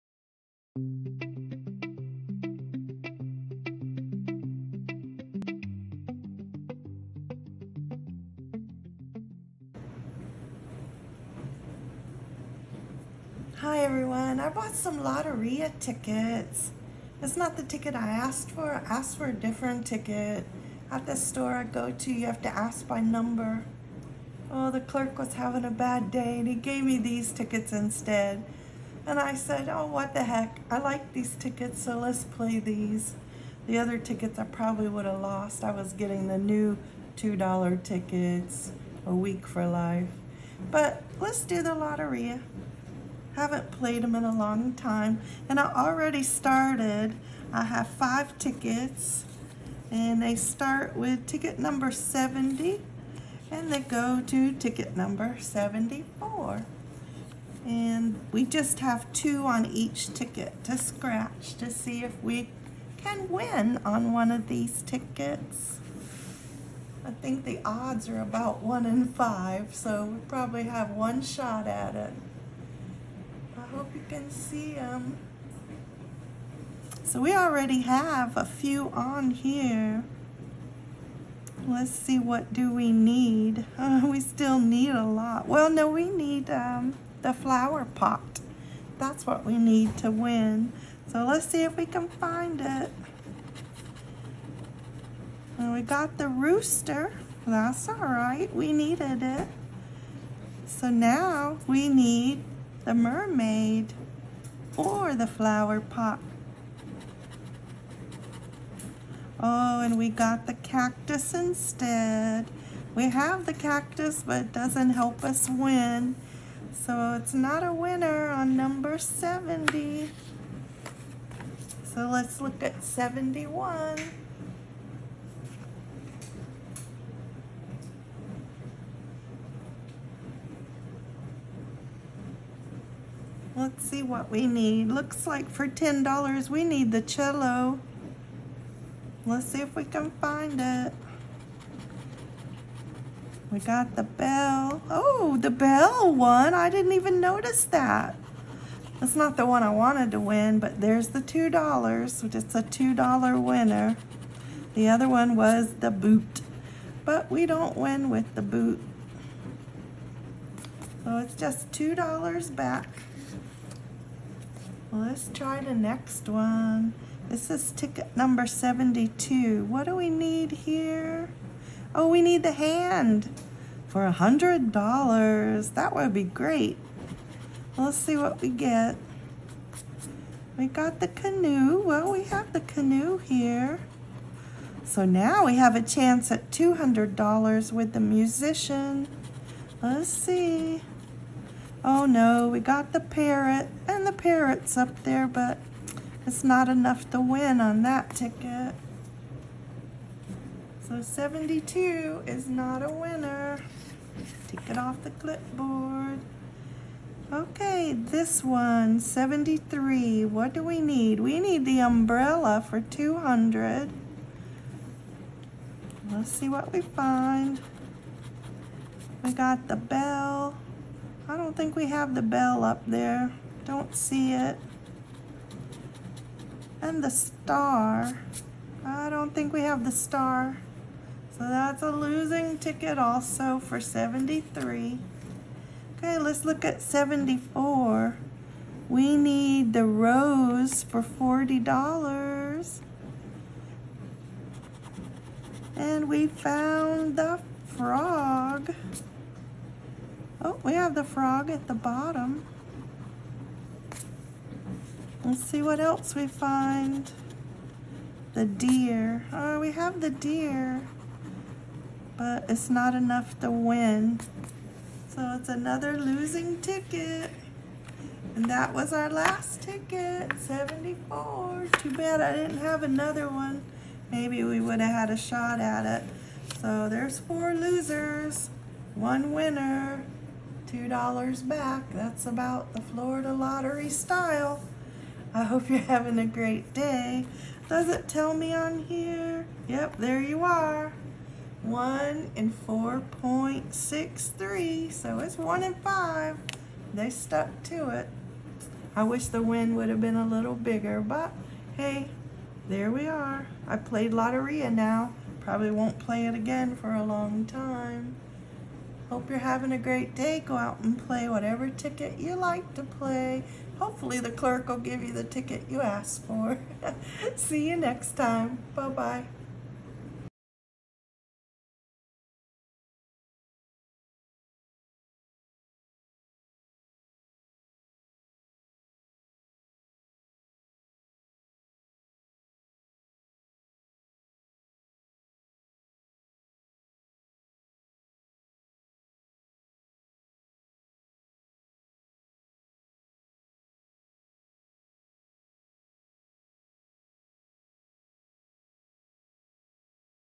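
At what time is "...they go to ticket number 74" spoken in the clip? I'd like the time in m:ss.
0:53.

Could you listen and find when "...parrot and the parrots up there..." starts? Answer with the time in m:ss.
3:12.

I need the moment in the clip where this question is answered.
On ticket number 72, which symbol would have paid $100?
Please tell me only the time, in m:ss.
2:52.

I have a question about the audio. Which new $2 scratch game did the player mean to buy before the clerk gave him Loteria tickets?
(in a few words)
a week for life.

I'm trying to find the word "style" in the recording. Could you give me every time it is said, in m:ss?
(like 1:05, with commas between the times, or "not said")
4:43.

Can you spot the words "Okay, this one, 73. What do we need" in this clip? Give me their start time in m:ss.
3:27.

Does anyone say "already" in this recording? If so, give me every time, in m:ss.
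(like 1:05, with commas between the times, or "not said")
0:45, 1:17.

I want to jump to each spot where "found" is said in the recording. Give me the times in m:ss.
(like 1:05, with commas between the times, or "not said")
4:06.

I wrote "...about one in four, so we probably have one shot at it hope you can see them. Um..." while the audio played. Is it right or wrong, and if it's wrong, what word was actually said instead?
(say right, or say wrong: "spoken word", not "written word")
wrong: "five", not "four".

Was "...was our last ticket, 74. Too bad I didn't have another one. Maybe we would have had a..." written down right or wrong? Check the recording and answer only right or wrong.
right.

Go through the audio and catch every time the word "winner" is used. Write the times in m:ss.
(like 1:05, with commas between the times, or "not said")
1:57, 2:33, 3:22, 4:39.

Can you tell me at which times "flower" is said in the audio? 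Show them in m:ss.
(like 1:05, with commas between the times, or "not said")
1:27, 1:45.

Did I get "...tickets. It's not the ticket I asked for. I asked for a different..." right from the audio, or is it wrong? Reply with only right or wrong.
right.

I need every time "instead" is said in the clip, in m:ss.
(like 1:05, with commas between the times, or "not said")
0:27, 1:51.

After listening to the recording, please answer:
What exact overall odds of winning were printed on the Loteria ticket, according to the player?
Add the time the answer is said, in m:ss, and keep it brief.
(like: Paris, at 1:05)
1 in 4.63, at 4:51.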